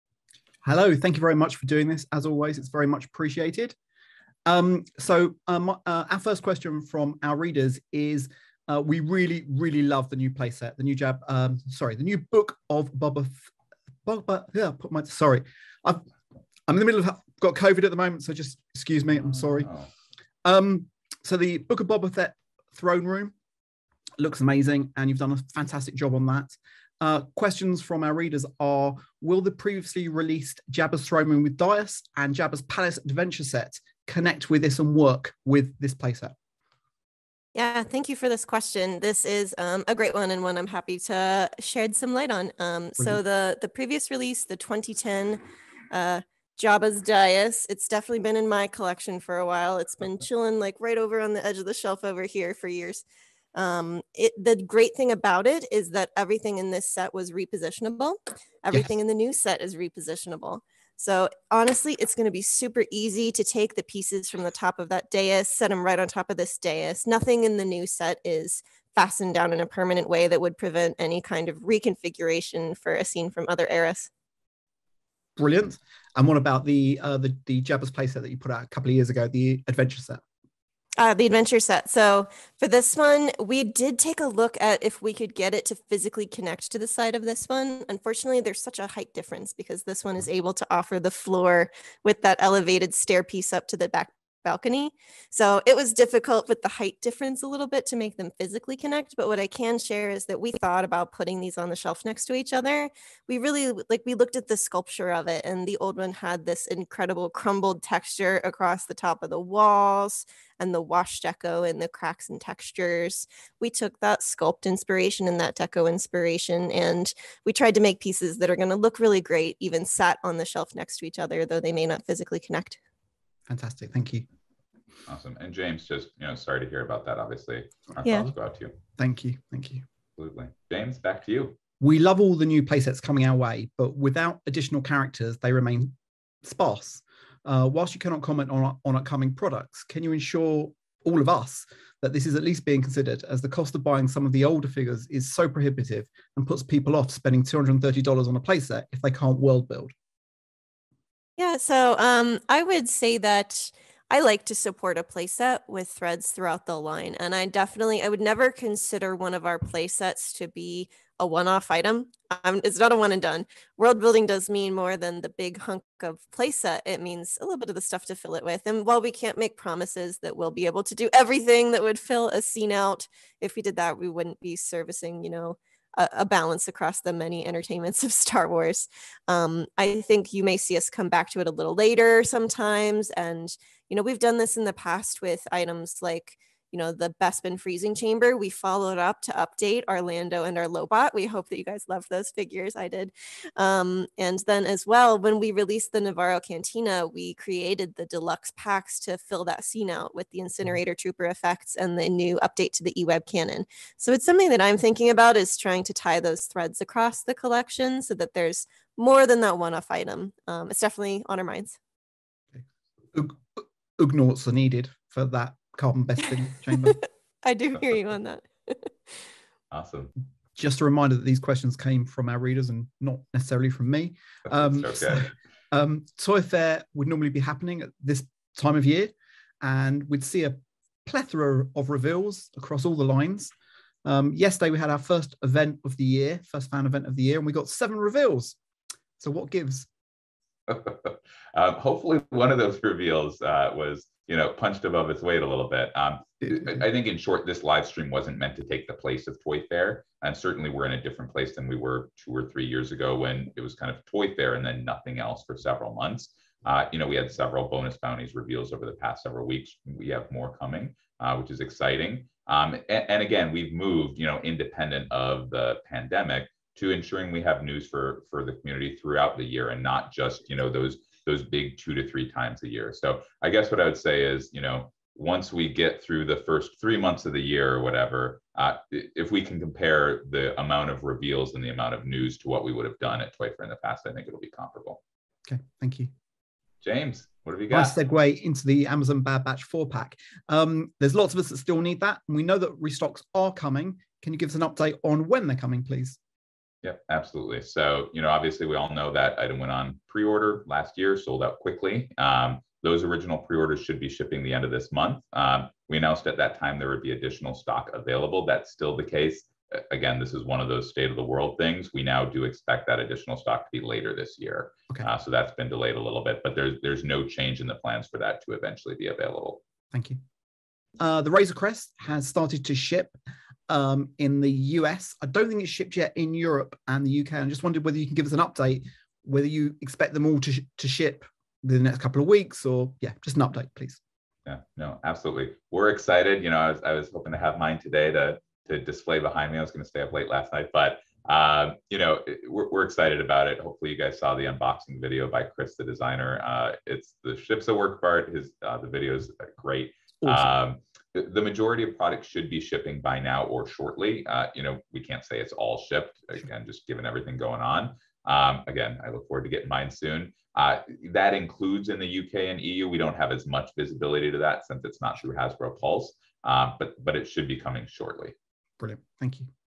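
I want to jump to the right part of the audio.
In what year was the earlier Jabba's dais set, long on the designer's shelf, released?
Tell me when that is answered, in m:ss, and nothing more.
0:44.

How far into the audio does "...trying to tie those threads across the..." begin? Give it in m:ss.
3:25.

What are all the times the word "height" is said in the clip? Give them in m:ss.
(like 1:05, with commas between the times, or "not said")
1:28, 1:36.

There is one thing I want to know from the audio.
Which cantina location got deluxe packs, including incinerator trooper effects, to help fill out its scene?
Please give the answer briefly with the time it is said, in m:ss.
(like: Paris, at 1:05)
Nevarro, at 3:15.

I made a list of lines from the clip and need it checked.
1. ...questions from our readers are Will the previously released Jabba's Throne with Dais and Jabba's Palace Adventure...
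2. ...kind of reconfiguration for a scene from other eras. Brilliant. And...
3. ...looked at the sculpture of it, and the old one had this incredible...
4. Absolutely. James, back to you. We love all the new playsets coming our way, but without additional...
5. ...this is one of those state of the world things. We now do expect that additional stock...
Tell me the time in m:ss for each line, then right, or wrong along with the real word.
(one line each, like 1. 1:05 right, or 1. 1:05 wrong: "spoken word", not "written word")
1. 0:27 right
2. 1:11 right
3. 1:44 right
4. 2:10 right
5. 5:10 right.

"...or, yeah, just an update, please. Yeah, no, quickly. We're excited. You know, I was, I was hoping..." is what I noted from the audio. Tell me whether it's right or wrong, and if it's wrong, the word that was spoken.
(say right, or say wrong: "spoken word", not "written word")
wrong: "absolutely", not "quickly".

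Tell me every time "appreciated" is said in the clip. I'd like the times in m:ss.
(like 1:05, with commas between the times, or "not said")
0:03.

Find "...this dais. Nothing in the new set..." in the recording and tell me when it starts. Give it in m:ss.
1:06.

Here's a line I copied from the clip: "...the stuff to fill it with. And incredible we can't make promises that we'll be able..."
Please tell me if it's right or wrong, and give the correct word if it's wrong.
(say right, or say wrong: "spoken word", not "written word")
wrong: "while", not "incredible".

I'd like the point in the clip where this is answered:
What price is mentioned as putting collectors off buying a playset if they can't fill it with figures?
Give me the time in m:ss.
2:27.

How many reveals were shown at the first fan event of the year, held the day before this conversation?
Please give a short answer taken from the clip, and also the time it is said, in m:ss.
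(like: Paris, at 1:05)
Seven, at 3:57.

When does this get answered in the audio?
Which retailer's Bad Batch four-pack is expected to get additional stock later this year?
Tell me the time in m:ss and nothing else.
4:48.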